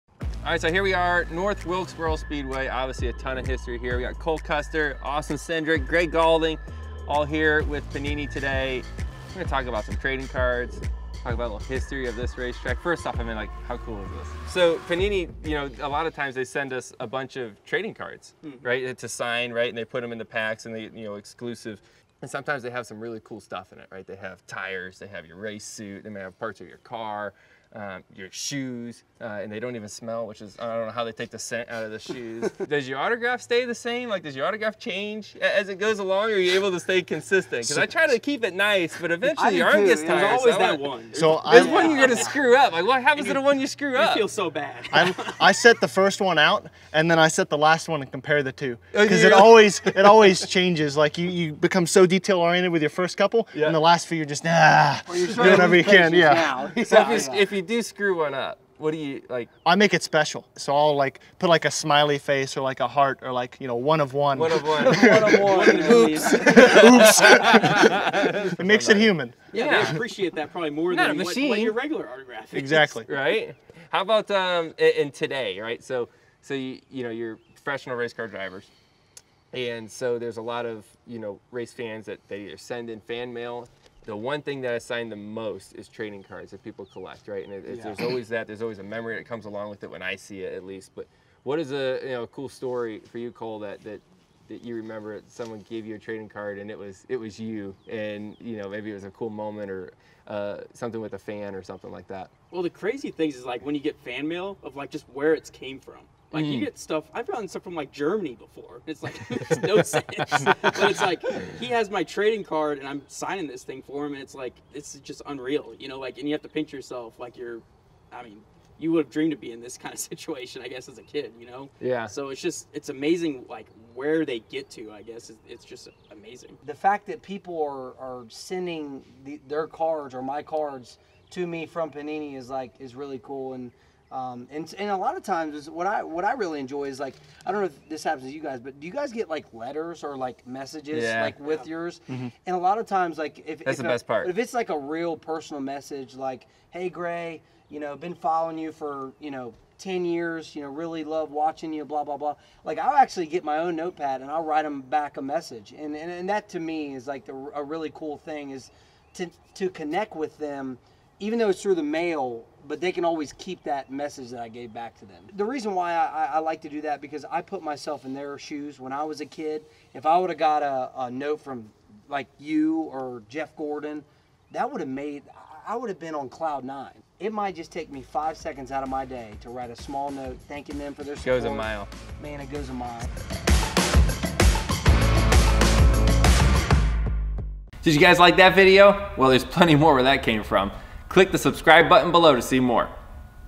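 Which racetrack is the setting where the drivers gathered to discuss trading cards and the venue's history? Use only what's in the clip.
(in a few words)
North Wilkesboro Speedway.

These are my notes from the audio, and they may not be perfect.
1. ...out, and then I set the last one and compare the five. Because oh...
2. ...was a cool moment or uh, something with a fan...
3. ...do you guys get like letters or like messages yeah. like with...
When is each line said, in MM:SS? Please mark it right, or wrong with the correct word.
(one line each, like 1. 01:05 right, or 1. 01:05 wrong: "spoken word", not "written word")
1. 00:46 wrong: "two", not "five"
2. 01:38 right
3. 02:18 right.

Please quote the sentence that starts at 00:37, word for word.
Because I try to keep it nice, but eventually your arm gets tired.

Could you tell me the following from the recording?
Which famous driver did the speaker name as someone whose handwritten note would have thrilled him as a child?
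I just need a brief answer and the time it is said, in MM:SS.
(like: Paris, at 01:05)
Jeff Gordon, at 02:53.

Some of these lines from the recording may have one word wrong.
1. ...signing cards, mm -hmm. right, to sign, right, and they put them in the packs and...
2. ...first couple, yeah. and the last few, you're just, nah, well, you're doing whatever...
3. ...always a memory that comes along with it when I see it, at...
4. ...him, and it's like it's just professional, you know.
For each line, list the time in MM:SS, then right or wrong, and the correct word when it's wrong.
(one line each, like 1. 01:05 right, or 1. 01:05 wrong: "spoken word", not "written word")
1. 00:17 wrong: "trading", not "signing"
2. 00:52 right
3. 01:28 right
4. 01:54 wrong: "unreal", not "professional".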